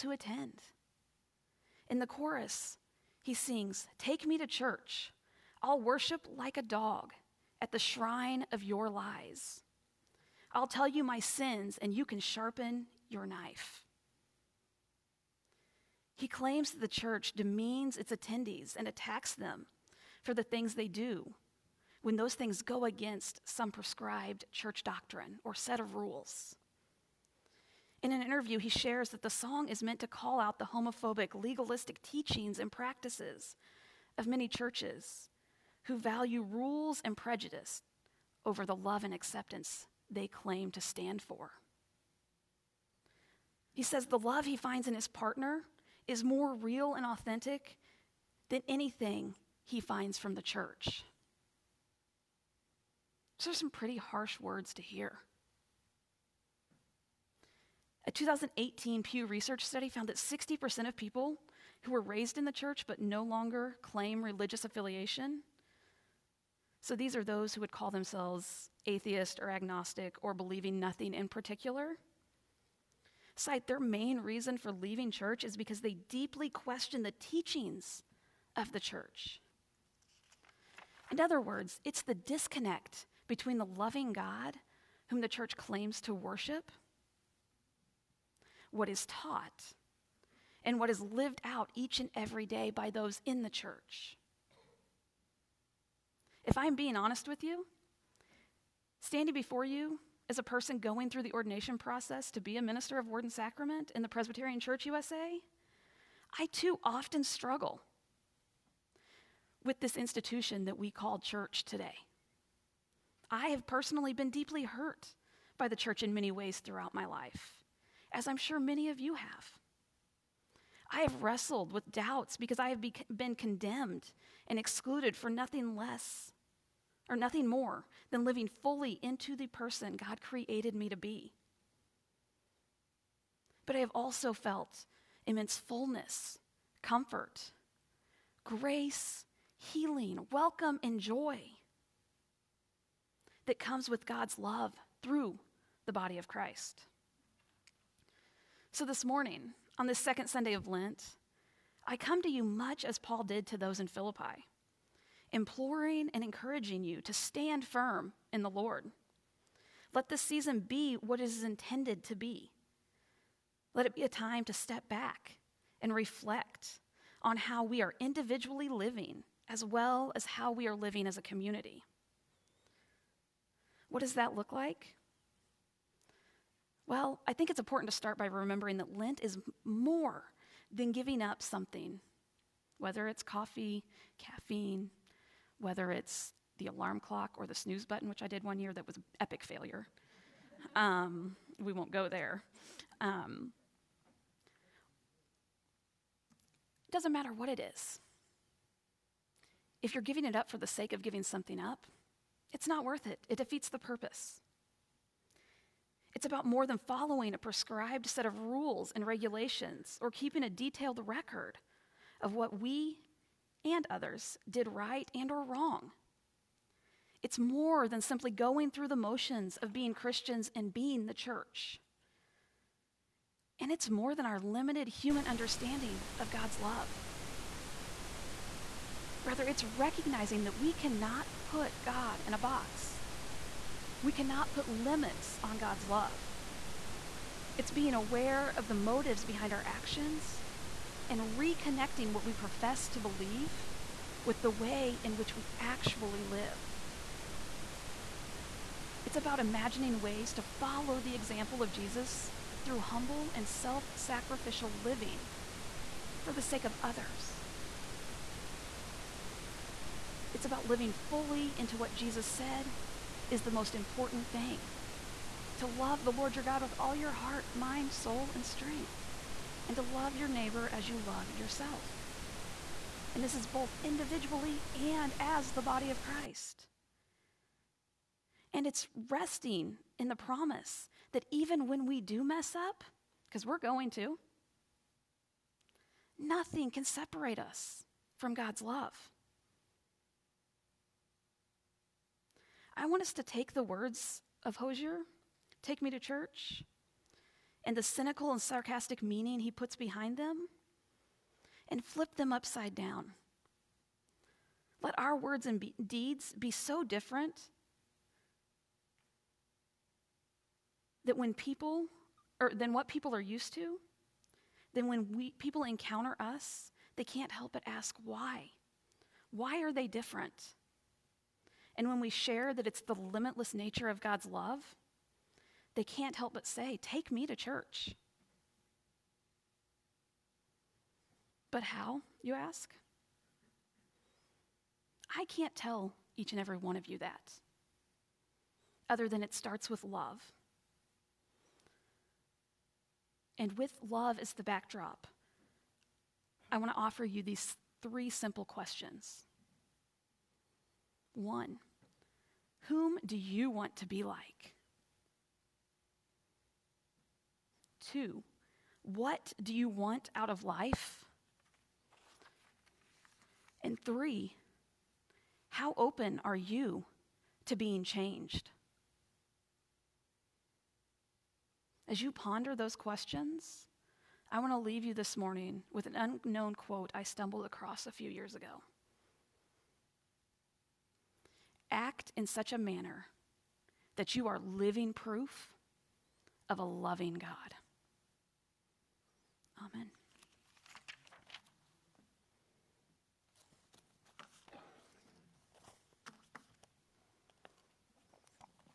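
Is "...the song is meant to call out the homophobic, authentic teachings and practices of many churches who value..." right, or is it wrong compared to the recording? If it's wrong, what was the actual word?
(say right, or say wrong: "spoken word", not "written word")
wrong: "legalistic", not "authentic".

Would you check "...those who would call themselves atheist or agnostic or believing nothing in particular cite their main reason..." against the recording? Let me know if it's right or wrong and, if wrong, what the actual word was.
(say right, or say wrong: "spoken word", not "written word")
right.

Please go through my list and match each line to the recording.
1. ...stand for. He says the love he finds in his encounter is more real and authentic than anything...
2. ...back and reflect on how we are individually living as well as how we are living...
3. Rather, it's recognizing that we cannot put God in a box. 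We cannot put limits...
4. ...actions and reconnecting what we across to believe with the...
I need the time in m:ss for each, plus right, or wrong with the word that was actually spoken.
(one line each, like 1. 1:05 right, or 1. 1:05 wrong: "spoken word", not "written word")
1. 0:40 wrong: "partner", not "encounter"
2. 2:44 right
3. 3:49 right
4. 3:59 wrong: "profess", not "across".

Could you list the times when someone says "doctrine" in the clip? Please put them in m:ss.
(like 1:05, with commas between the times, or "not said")
0:24.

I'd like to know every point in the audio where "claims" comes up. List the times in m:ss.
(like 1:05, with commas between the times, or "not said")
0:16, 0:40, 1:03, 1:25.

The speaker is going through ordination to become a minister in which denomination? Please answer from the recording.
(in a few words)
Presbyterian Church USA.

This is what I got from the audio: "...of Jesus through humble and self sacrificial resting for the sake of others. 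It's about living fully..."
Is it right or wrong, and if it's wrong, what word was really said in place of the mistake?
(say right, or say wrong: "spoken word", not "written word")
wrong: "living", not "resting".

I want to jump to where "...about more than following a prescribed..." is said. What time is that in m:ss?
3:26.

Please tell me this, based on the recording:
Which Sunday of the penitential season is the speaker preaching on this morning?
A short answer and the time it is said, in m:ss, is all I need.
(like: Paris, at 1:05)
Second Sunday of Lent, at 2:29.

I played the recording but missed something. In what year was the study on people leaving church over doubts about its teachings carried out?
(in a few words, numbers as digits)
2018.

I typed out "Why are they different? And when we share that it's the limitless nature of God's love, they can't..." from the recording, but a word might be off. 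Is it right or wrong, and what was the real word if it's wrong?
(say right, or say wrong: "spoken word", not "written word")
right.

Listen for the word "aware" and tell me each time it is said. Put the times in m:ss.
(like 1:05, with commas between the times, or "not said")
3:57.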